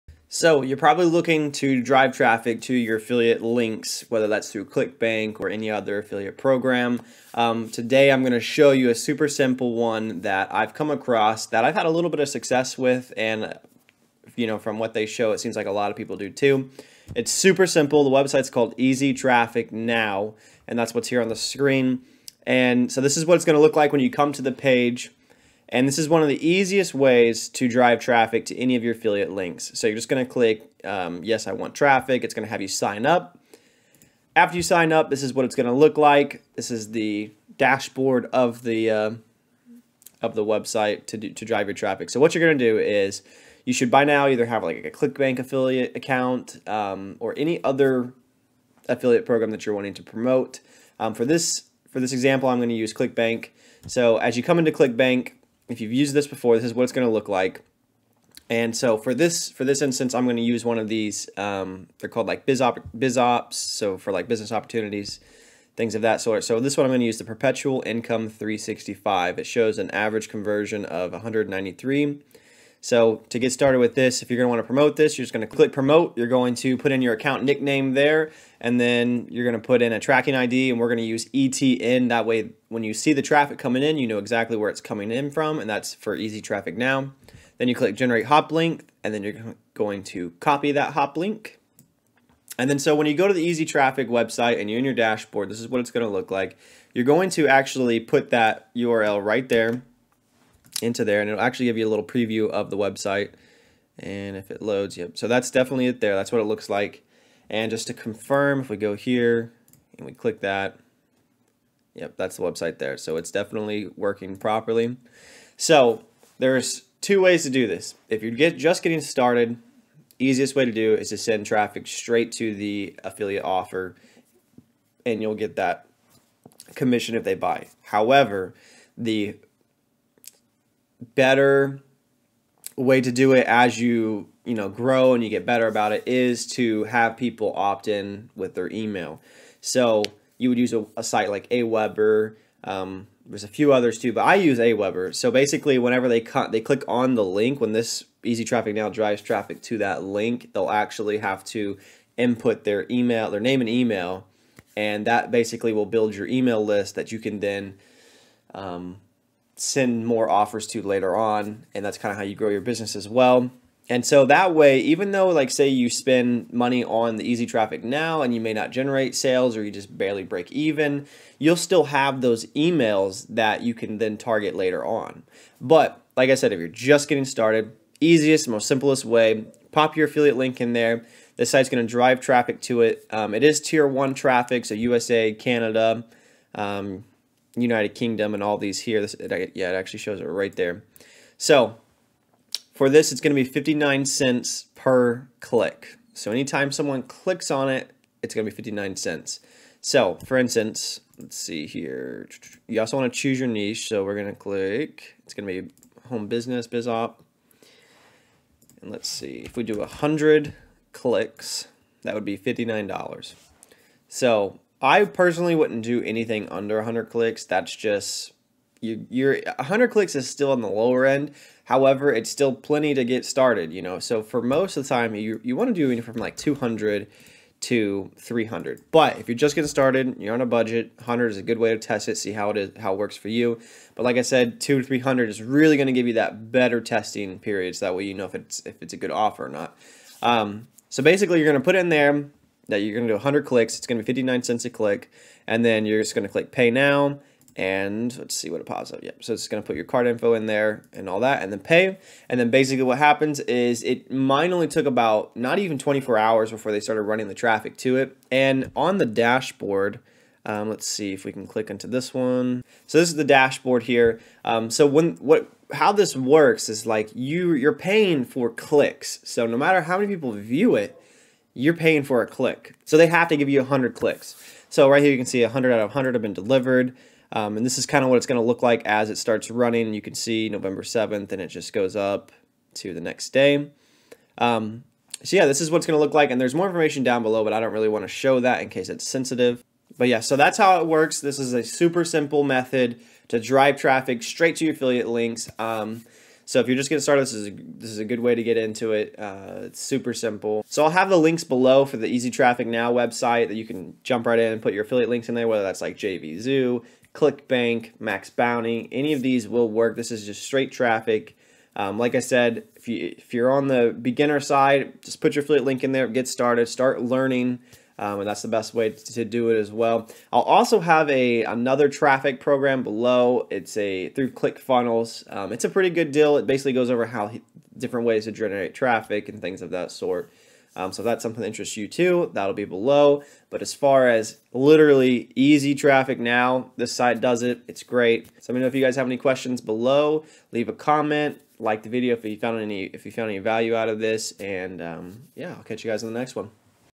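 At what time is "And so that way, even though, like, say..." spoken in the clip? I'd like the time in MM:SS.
02:43.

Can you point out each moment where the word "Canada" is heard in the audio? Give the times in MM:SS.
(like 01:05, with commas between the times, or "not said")
03:05.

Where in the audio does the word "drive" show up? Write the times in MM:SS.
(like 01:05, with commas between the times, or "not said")
00:01, 00:27, 00:41, 02:28, 03:01, 04:53.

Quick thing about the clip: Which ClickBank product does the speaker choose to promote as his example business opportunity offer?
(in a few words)
Perpetual Income 365.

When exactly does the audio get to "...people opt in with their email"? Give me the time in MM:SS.
02:17.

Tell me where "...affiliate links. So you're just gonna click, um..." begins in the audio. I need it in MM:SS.
00:28.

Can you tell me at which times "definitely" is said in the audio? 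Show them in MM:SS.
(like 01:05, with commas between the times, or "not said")
01:45, 01:53.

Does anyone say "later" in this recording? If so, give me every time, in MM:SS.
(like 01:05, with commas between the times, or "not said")
02:40, 02:54.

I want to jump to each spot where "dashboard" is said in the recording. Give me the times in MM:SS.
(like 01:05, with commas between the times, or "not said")
00:37, 01:34, 04:19, 04:23.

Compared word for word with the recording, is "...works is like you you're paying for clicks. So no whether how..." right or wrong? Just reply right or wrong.
wrong.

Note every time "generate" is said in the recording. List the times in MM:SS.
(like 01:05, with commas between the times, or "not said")
01:27, 02:48, 05:28.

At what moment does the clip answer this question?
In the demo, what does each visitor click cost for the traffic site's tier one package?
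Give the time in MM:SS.
03:13.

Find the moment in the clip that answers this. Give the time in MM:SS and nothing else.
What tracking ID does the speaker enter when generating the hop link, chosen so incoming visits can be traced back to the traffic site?
01:21.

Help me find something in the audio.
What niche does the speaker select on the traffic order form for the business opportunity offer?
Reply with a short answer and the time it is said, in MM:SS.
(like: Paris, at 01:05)
home business, biz op, at 03:26.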